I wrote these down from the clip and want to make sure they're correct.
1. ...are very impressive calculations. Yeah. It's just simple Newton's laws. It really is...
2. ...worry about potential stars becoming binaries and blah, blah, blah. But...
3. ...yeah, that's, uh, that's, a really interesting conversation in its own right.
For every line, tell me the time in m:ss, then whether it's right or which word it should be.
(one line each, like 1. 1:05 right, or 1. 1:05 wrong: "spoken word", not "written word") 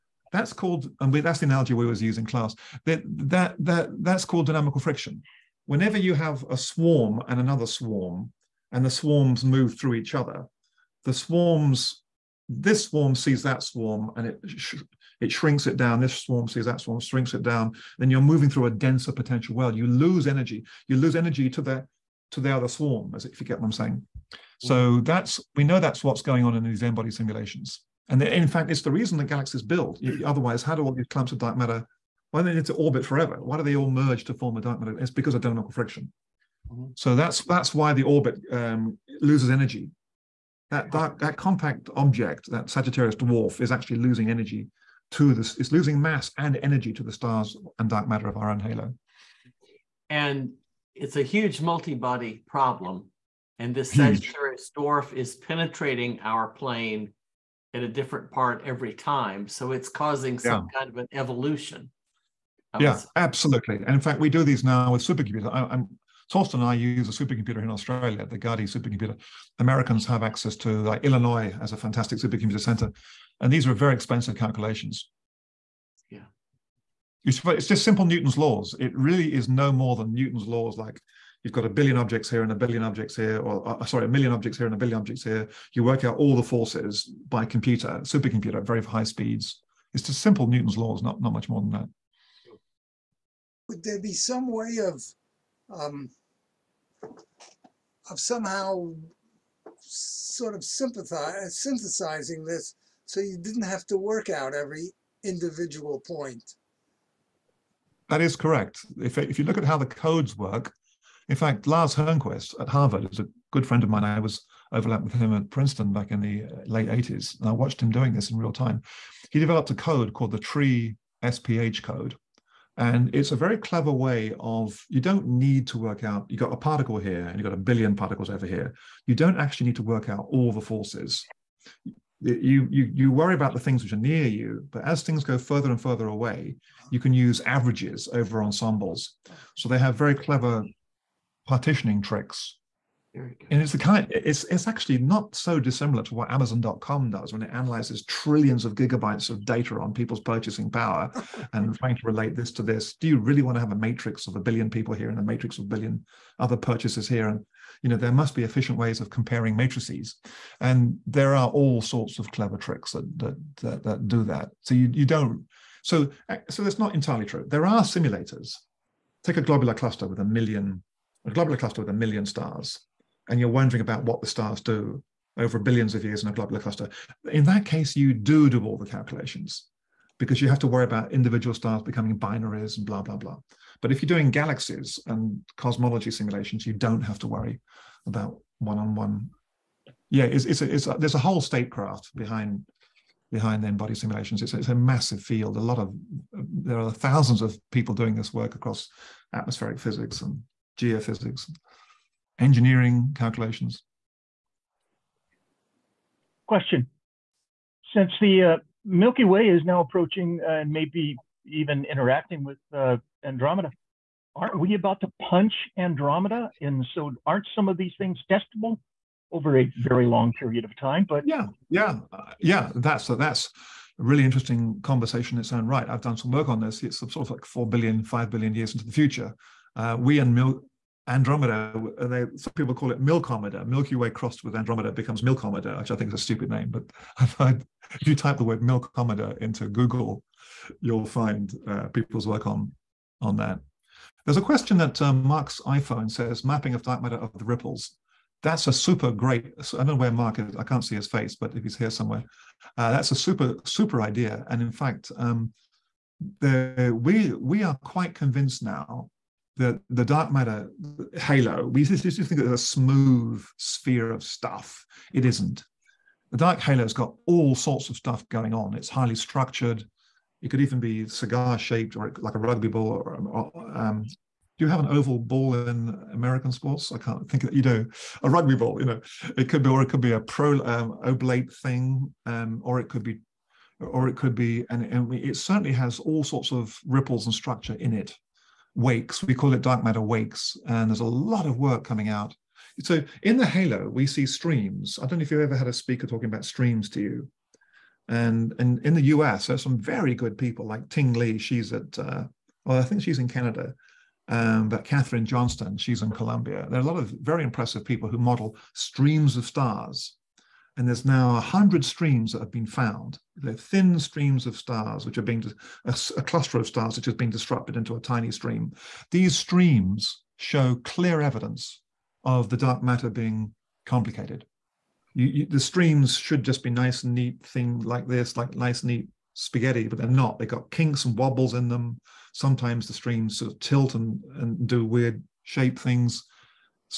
1. 1:13 wrong: "expensive", not "impressive"
2. 3:00 wrong: "individual", not "potential"
3. 3:42 right.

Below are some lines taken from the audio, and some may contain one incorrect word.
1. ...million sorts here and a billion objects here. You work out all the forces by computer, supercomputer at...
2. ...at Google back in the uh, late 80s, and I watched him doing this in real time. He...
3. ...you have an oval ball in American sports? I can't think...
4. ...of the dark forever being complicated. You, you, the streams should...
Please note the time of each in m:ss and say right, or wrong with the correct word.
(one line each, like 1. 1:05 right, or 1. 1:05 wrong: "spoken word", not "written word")
1. 1:24 wrong: "objects", not "sorts"
2. 1:55 wrong: "Princeton", not "Google"
3. 4:34 right
4. 5:22 wrong: "matter", not "forever".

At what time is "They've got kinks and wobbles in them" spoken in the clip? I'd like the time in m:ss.
5:30.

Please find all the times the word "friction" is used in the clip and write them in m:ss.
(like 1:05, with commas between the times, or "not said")
0:04, 0:35.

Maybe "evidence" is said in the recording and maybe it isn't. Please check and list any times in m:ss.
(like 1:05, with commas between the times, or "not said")
5:21.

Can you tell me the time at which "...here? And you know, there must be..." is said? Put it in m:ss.
2:37.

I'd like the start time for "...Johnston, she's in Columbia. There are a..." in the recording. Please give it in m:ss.
5:05.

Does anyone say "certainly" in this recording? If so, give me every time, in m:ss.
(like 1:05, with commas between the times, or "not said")
4:45.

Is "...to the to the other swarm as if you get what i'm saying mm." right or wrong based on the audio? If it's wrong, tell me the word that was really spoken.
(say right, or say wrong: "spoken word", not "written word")
right.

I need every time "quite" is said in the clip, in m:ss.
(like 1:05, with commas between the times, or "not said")
4:17.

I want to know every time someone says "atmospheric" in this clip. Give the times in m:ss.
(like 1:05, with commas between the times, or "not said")
3:19.